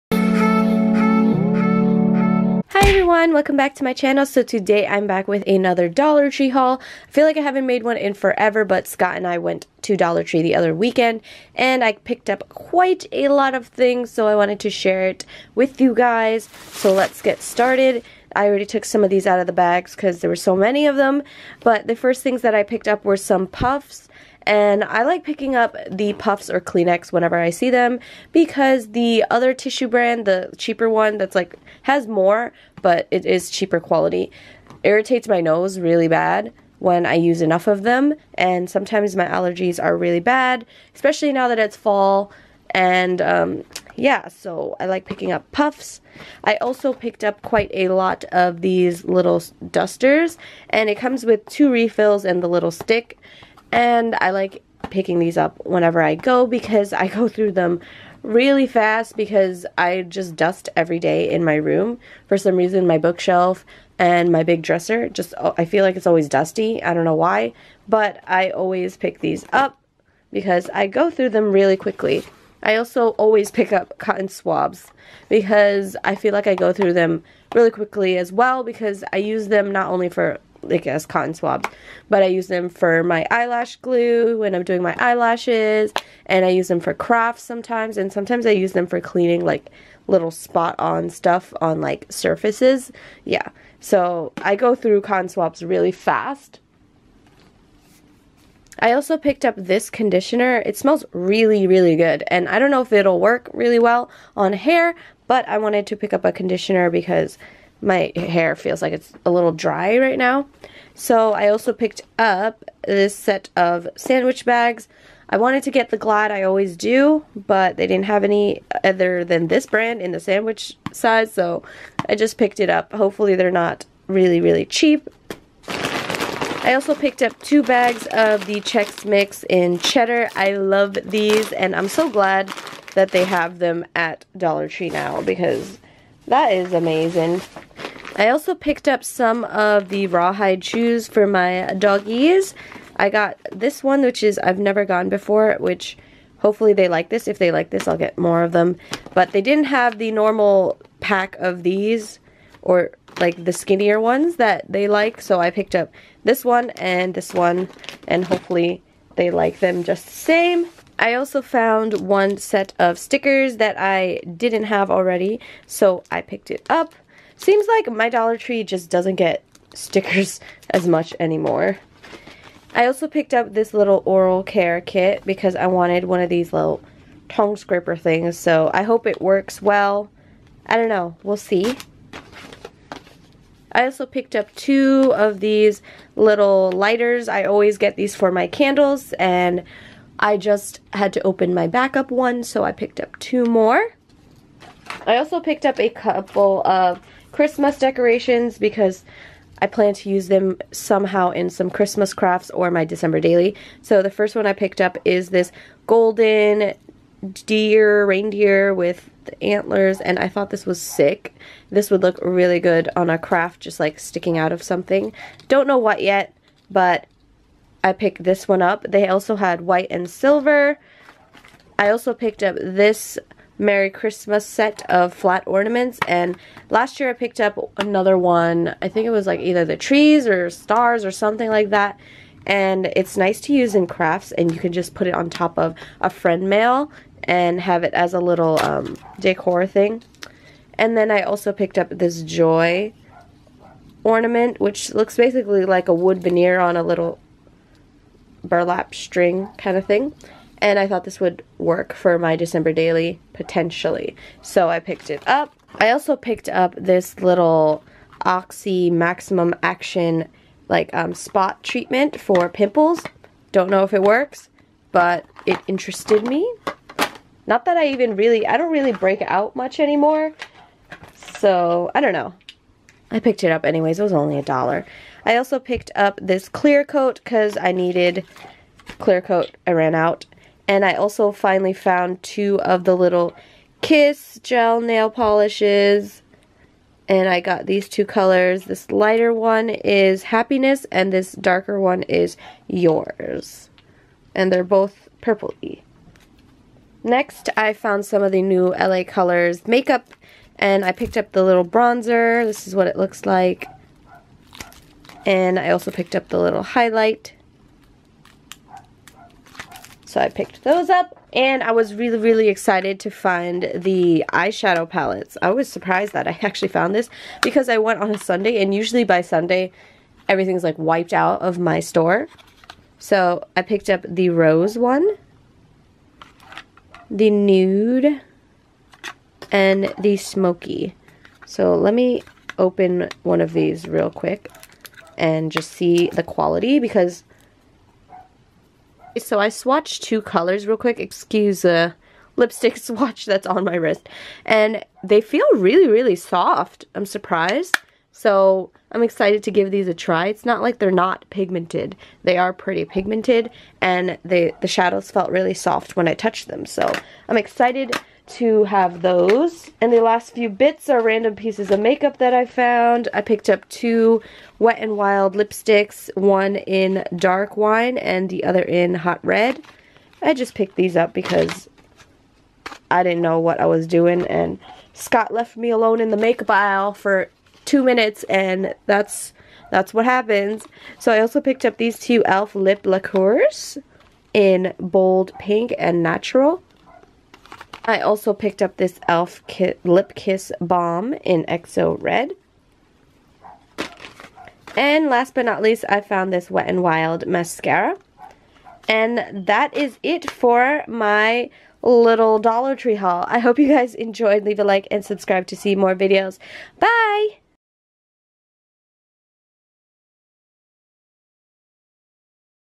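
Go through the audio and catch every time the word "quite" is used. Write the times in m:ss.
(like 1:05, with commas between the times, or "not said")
0:12, 0:47.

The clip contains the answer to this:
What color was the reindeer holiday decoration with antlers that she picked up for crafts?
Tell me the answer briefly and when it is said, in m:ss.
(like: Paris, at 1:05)
Golden, at 3:25.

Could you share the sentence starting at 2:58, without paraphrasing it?
So I hope it works well.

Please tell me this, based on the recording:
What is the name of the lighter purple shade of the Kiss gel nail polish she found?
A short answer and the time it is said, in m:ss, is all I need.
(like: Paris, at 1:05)
Happiness, at 4:50.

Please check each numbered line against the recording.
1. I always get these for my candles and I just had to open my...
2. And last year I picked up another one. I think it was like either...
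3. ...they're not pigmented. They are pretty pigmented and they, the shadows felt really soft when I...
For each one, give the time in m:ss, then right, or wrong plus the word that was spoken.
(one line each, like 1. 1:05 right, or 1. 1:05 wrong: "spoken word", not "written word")
1. 3:07 right
2. 3:46 right
3. 5:50 right.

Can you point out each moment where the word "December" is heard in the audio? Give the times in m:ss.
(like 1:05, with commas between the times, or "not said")
3:22, 4:12.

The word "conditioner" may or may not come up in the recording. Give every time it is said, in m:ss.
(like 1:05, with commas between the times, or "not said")
1:39, 1:46.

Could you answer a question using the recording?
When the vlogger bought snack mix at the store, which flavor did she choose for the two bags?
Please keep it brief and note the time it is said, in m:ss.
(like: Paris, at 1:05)
Cheddar, at 2:09.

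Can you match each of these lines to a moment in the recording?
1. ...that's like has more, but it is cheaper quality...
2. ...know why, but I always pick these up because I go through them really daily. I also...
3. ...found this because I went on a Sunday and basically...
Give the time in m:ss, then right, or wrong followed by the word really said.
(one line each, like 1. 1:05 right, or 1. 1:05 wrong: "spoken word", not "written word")
1. 0:31 right
2. 1:07 wrong: "quickly", not "daily"
3. 5:16 wrong: "usually", not "basically".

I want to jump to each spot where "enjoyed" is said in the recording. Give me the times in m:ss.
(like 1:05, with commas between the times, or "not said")
6:43.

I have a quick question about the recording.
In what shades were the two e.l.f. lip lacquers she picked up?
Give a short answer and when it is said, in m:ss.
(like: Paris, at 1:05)
Bold pink and natural, at 6:24.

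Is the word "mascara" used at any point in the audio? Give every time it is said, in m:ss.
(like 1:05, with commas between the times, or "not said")
6:37.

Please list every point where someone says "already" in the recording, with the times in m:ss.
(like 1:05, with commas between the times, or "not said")
0:18, 2:44.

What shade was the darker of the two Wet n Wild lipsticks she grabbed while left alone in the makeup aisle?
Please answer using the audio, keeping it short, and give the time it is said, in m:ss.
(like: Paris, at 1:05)
Dark wine, at 6:07.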